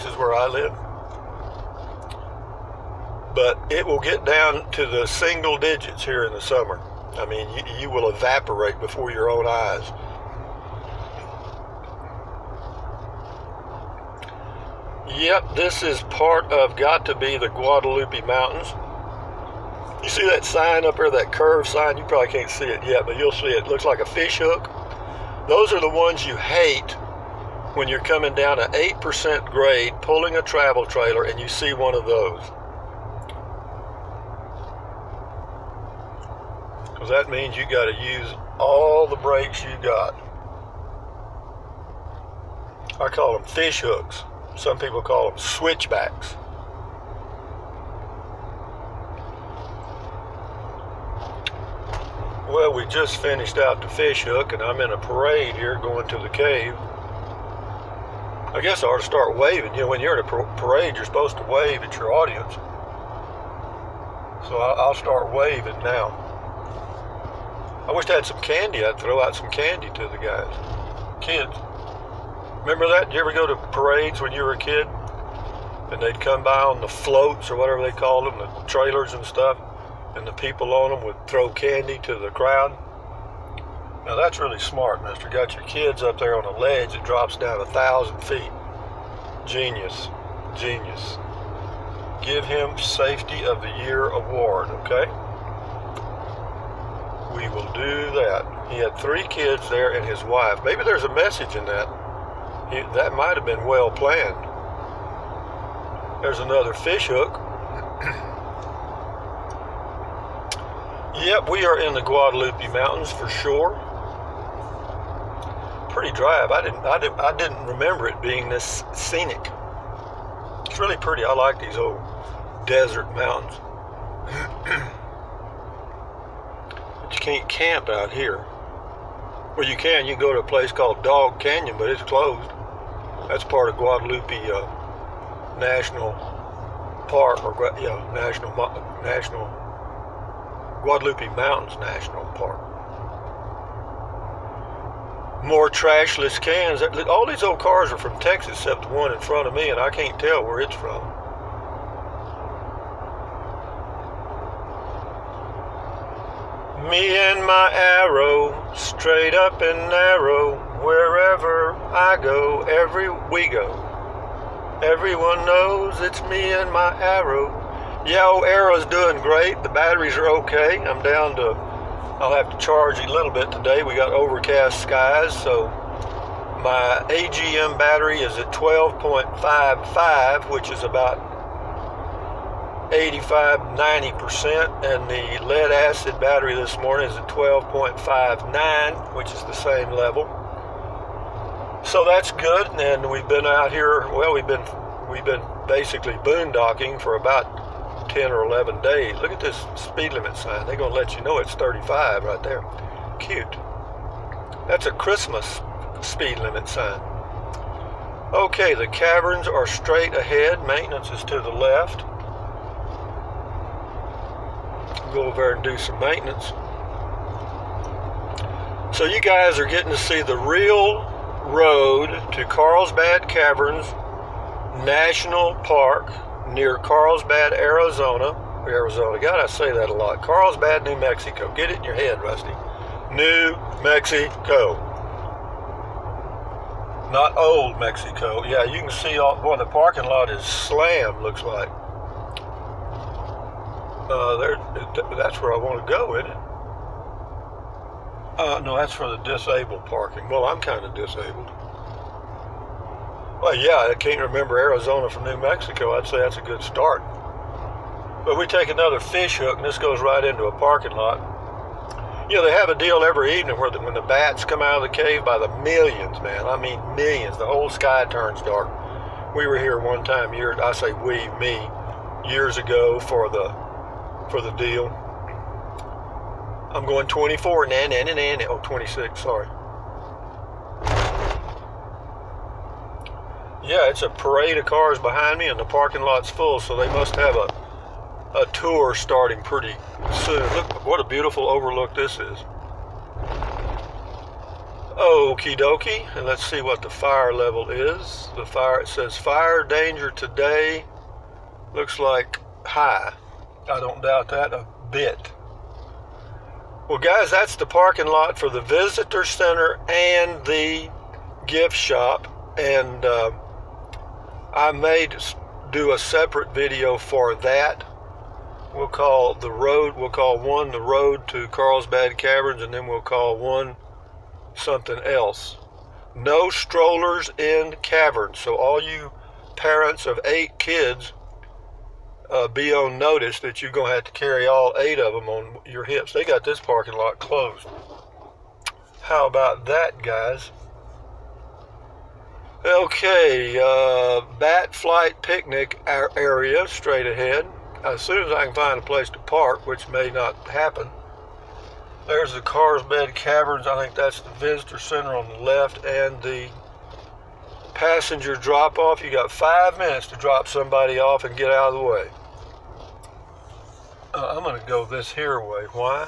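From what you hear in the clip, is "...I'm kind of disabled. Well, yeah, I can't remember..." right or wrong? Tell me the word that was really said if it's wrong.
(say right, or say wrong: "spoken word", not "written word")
right.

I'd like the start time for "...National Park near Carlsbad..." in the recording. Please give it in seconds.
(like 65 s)
224 s.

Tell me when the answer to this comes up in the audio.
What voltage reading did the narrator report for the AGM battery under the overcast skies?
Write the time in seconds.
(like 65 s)
178 s.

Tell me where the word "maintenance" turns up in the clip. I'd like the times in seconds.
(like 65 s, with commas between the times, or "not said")
210 s, 215 s.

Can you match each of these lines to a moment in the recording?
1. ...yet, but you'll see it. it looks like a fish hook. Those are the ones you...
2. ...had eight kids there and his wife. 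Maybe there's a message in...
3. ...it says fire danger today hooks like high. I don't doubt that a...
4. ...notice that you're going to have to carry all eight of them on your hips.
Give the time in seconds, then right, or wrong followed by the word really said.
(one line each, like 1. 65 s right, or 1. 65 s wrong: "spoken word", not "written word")
1. 22 s right
2. 98 s wrong: "three", not "eight"
3. 298 s wrong: "looks", not "hooks"
4. 332 s right.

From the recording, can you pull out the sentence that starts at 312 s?
And uh, I may do a separate video for that.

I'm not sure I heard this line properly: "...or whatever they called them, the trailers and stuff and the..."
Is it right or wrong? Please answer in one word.
right.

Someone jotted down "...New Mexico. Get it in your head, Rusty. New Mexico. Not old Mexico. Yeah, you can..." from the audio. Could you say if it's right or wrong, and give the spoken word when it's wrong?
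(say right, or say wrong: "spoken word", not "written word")
right.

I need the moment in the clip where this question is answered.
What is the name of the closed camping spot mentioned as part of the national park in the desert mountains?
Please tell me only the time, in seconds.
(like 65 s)
131 s.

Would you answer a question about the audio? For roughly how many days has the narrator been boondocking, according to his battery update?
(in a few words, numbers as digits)
10 or 11 days.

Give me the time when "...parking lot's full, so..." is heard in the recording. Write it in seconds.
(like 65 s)
285 s.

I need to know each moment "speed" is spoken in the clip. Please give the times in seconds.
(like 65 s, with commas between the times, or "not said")
199 s, 206 s.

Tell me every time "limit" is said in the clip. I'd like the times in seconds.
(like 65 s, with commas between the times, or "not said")
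200 s, 206 s.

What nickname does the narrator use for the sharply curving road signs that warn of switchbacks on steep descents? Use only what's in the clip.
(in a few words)
Fish hooks.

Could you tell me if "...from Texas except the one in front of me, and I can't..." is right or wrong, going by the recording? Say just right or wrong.
right.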